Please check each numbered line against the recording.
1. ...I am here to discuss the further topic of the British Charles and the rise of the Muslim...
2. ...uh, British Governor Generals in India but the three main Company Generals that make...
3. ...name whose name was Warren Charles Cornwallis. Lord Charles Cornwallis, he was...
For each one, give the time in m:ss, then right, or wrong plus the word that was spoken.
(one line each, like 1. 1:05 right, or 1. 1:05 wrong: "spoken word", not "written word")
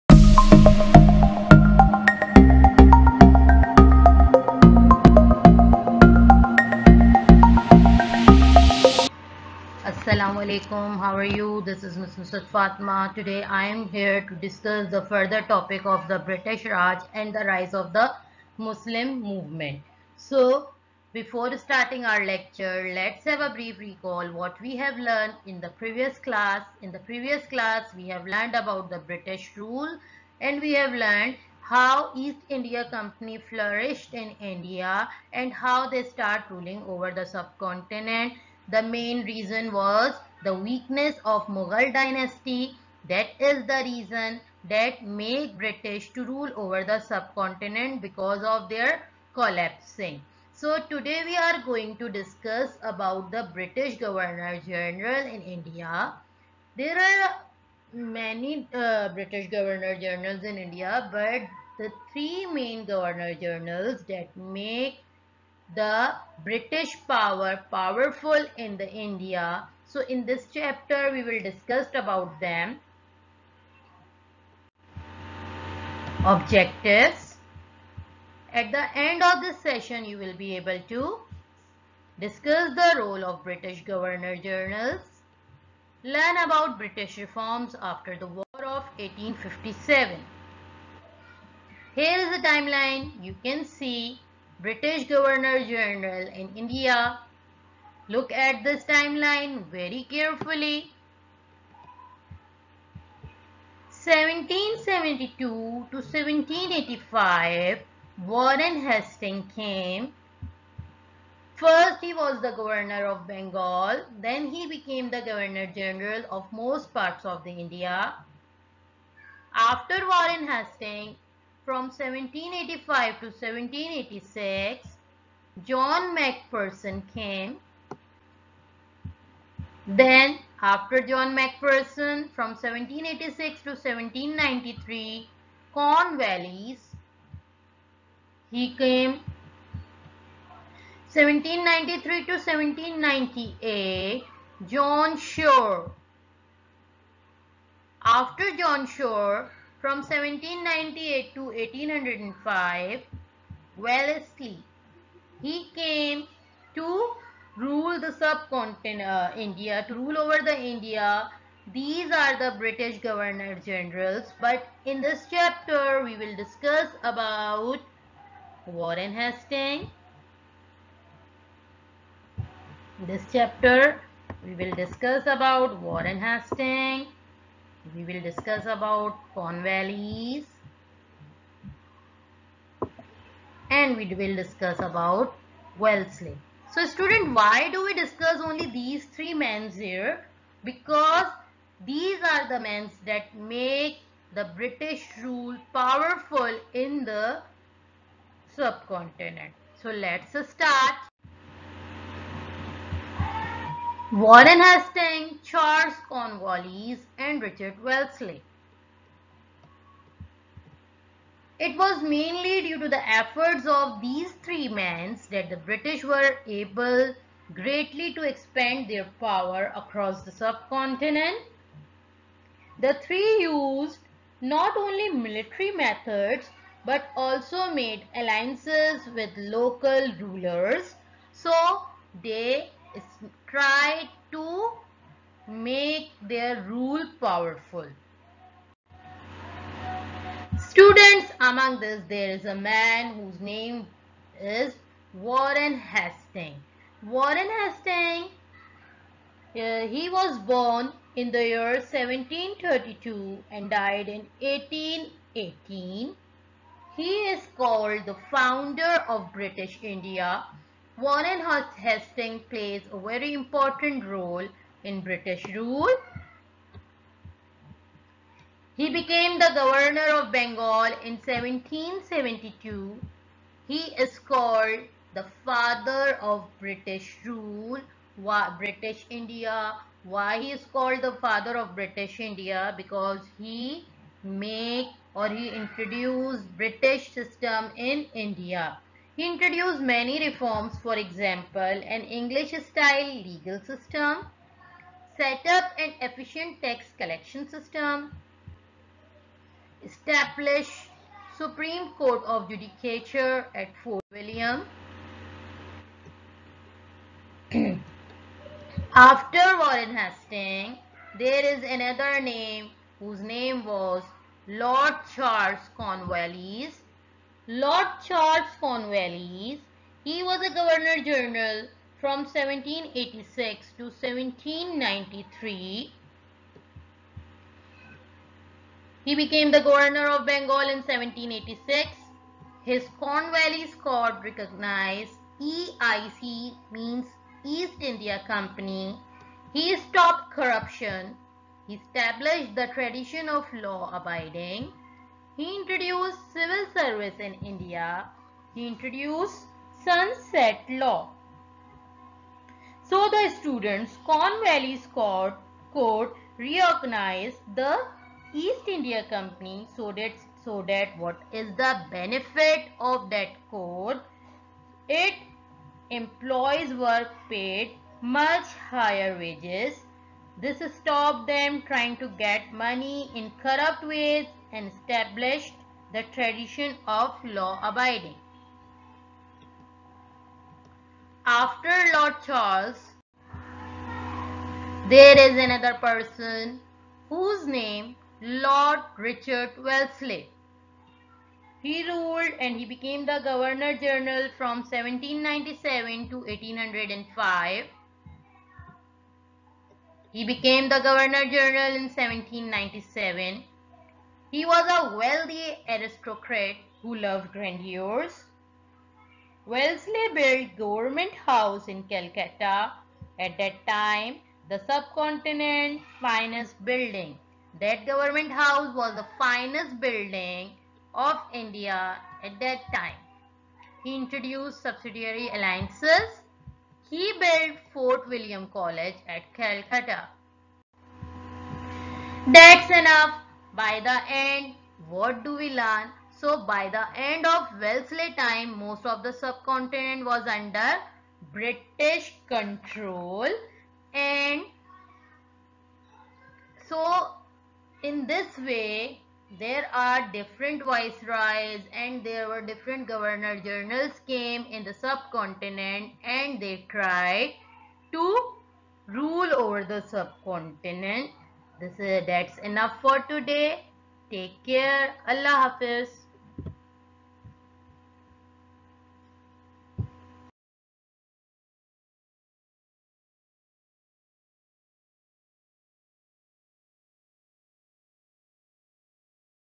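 1. 0:13 wrong: "Raj", not "Charles"
2. 0:58 wrong: "Governor", not "Company"
3. 5:12 wrong: "Lord", not "Warren".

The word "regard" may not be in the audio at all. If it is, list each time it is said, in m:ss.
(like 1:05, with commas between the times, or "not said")
not said.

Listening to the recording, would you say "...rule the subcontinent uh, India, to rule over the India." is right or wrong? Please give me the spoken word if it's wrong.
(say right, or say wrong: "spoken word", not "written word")
right.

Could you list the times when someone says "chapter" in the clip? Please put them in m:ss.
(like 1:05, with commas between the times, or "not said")
1:10, 2:45, 2:53.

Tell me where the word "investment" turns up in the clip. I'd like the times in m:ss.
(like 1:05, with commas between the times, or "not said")
not said.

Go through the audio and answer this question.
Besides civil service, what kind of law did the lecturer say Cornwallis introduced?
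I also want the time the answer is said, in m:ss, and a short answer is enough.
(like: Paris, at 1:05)
sunset law, at 5:49.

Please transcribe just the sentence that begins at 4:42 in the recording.
Because he made or he introduced British system in India.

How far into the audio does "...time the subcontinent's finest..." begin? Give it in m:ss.
6:53.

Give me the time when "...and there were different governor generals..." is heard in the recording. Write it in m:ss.
7:31.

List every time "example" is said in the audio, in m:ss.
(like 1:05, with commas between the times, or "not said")
4:50.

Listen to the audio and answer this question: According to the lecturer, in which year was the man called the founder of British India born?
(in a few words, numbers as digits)
1732.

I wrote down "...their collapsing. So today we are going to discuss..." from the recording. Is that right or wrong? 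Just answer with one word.
right.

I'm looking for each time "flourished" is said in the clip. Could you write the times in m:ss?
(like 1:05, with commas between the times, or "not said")
0:33.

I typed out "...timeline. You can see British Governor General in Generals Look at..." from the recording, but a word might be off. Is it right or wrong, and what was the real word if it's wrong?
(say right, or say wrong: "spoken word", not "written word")
wrong: "India", not "Generals".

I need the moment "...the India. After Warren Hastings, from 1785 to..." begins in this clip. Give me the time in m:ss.
1:57.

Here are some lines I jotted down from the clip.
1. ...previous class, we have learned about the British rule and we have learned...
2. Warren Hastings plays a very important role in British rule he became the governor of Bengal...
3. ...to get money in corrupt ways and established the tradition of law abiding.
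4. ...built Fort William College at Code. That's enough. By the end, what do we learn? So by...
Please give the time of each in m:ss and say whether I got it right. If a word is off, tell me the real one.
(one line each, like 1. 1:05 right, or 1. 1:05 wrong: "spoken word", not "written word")
1. 0:26 right
2. 4:20 right
3. 6:11 right
4. 7:07 wrong: "Calcutta", not "Code".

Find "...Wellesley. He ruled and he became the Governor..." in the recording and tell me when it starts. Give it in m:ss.
6:29.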